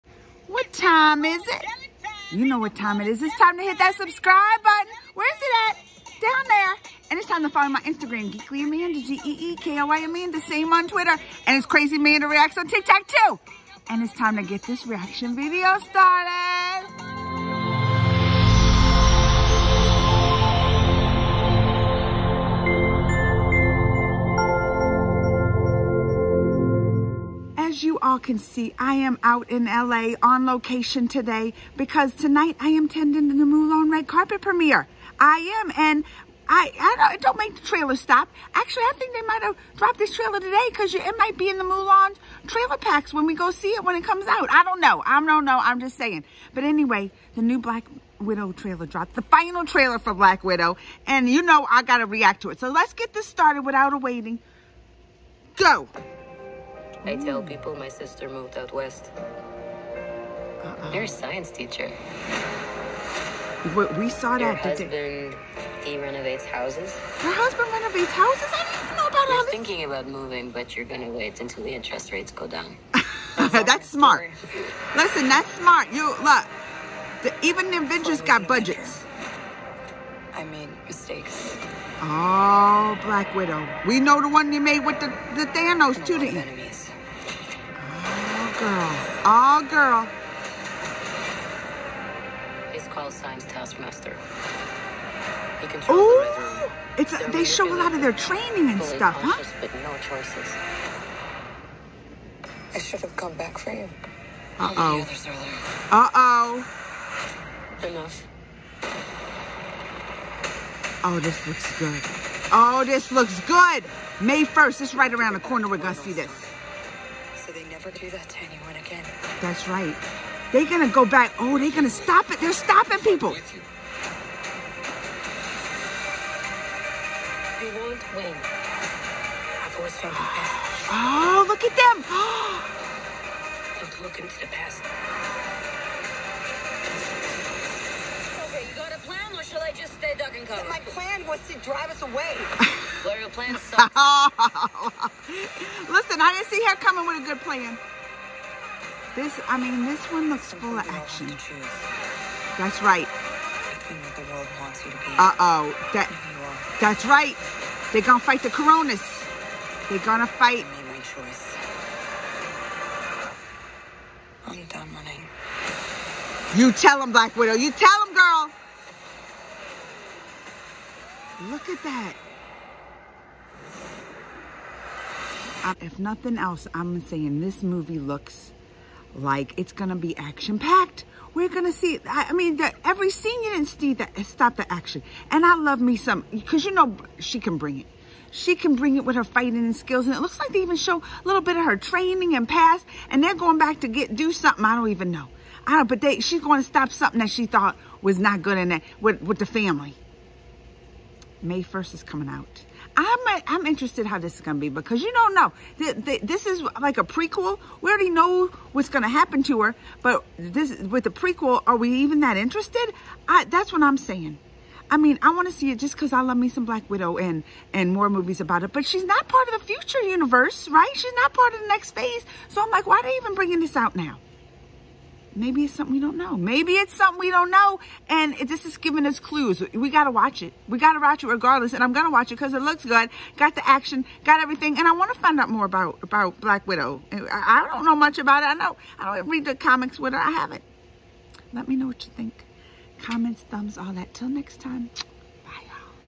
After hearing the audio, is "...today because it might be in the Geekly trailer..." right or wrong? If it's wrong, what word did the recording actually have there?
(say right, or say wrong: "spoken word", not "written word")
wrong: "Mulan", not "Geekly".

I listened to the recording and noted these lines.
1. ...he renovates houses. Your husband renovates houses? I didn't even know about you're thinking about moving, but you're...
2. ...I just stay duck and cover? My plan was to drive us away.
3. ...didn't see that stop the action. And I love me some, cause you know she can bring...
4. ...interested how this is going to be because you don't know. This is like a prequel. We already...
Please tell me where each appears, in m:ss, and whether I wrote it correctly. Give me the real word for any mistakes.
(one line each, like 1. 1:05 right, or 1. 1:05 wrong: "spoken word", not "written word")
1. 1:05 right
2. 2:19 right
3. 3:03 right
4. 3:23 right.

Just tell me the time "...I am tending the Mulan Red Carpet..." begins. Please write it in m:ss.
0:32.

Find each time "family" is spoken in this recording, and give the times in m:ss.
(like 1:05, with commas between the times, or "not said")
3:19.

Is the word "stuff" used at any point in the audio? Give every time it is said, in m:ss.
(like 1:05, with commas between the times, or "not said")
1:38.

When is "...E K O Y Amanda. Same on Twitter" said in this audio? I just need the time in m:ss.
0:09.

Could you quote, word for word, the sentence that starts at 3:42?
So I'm like, why are they even bringing this out now?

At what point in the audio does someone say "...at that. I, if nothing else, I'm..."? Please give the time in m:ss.
2:51.